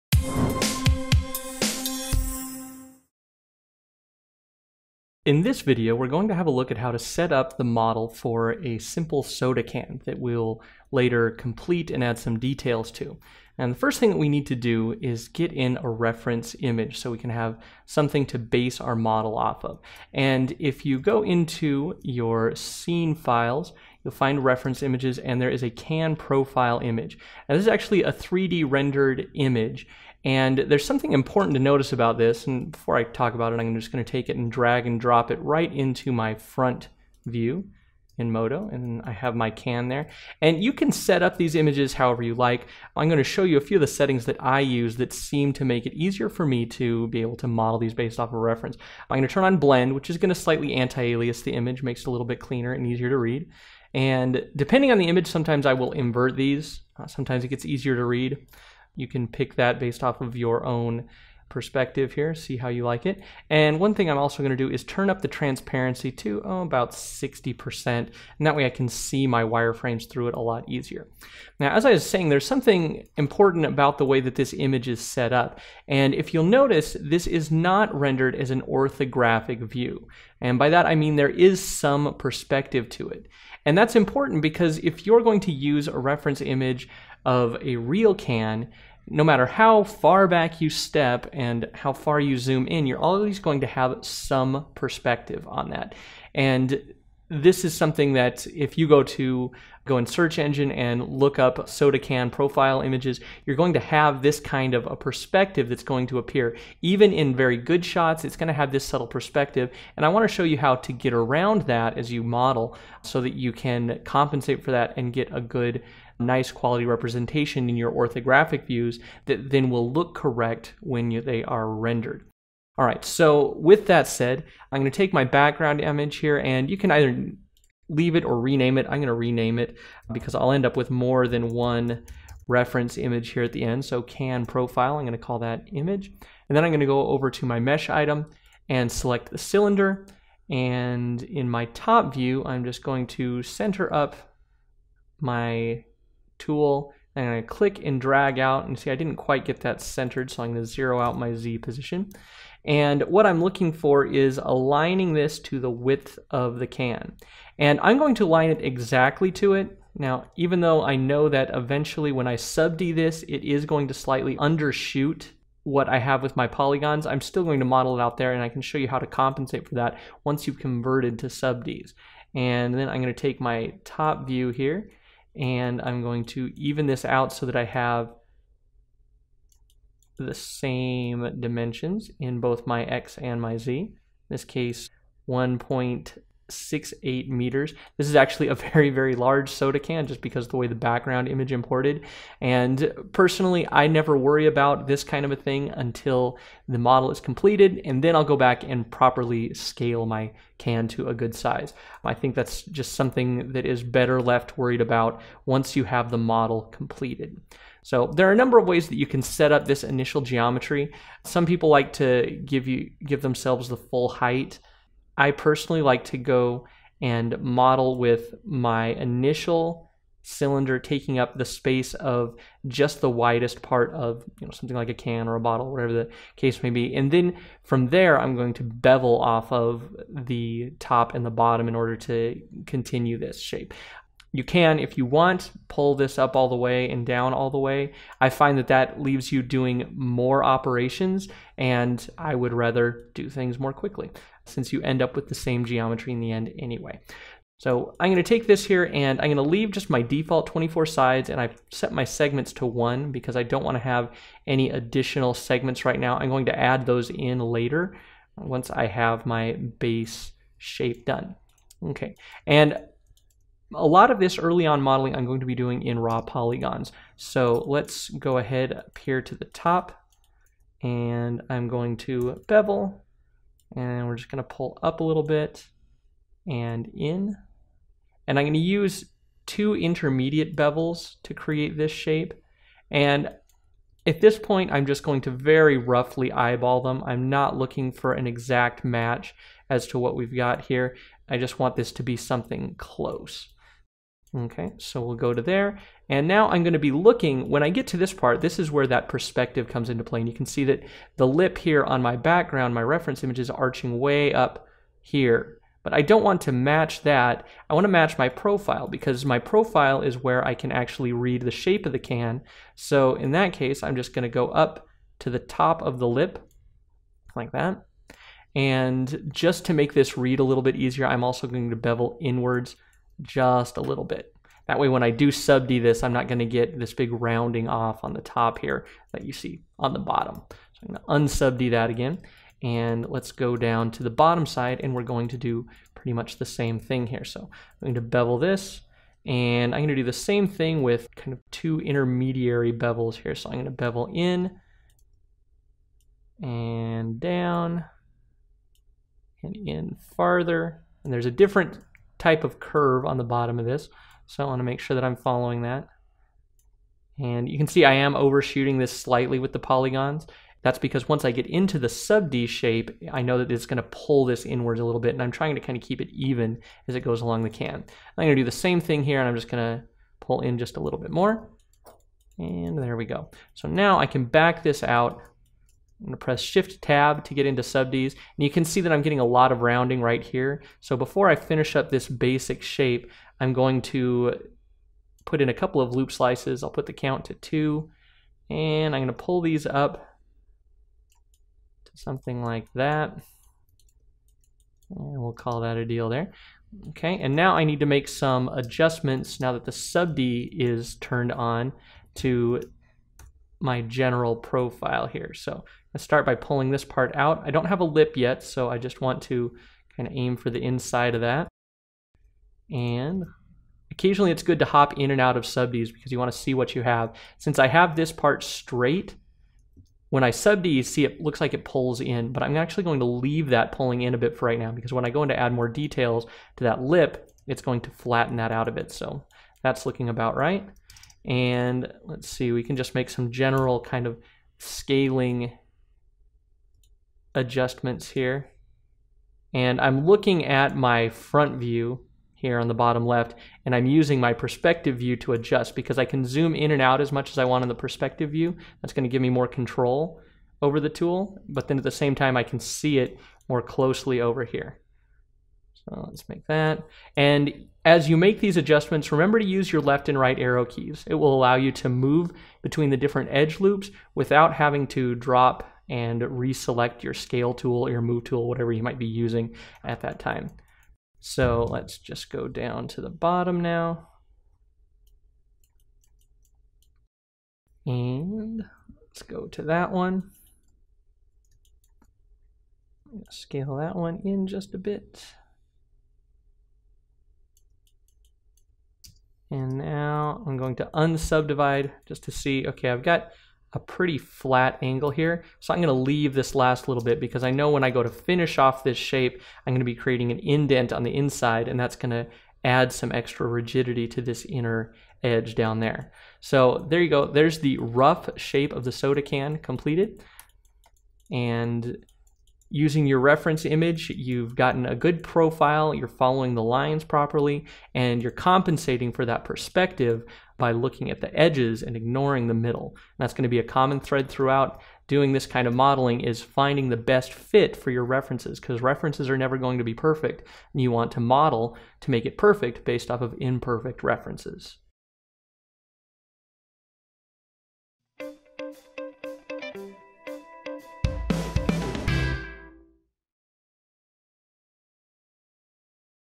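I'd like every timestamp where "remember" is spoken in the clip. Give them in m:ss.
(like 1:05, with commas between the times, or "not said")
7:39.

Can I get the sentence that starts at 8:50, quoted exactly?
And you want to model to make it perfect based off of imperfect references.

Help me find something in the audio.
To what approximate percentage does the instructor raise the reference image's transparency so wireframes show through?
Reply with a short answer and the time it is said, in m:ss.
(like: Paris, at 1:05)
60%, at 1:06.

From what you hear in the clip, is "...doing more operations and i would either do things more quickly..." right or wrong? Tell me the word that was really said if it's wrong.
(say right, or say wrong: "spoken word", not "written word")
wrong: "rather", not "either".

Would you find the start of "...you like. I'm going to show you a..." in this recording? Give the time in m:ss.
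0:42.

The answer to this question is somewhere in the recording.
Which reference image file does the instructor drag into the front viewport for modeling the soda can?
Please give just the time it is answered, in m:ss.
0:25.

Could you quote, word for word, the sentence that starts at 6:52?
And occasionally it's good to hop in and out of subDs because you want to see what you have.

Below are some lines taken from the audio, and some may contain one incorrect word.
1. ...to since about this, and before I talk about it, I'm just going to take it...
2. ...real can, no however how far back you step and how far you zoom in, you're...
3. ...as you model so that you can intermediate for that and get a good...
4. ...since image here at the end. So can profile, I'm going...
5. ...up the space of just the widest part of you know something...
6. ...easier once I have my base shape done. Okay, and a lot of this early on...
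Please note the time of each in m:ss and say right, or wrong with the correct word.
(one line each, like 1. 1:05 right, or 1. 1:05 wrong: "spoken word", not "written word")
1. 0:31 wrong: "notice", not "since"
2. 1:27 wrong: "matter", not "however"
3. 1:51 wrong: "compensate", not "intermediate"
4. 2:12 wrong: "reference", not "since"
5. 3:41 right
6. 4:17 wrong: "later", not "easier".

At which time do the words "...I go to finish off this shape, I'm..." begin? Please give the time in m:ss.
8:17.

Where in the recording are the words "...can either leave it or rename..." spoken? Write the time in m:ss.
2:06.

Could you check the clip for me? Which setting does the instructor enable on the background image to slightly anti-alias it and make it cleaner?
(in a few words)
blend.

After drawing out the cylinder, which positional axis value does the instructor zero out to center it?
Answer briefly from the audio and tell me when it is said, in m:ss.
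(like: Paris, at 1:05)
Z position, at 2:31.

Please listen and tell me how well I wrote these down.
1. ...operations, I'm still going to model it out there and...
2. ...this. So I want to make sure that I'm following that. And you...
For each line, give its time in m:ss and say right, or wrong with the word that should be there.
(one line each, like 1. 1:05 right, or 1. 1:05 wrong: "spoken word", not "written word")
1. 2:46 wrong: "polygons", not "operations"
2. 5:53 right.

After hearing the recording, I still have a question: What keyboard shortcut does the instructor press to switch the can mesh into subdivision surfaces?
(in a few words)
Shift Tab.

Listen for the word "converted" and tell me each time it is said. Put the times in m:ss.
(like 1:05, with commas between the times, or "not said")
2:50.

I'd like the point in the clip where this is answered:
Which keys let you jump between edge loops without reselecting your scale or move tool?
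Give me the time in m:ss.
7:39.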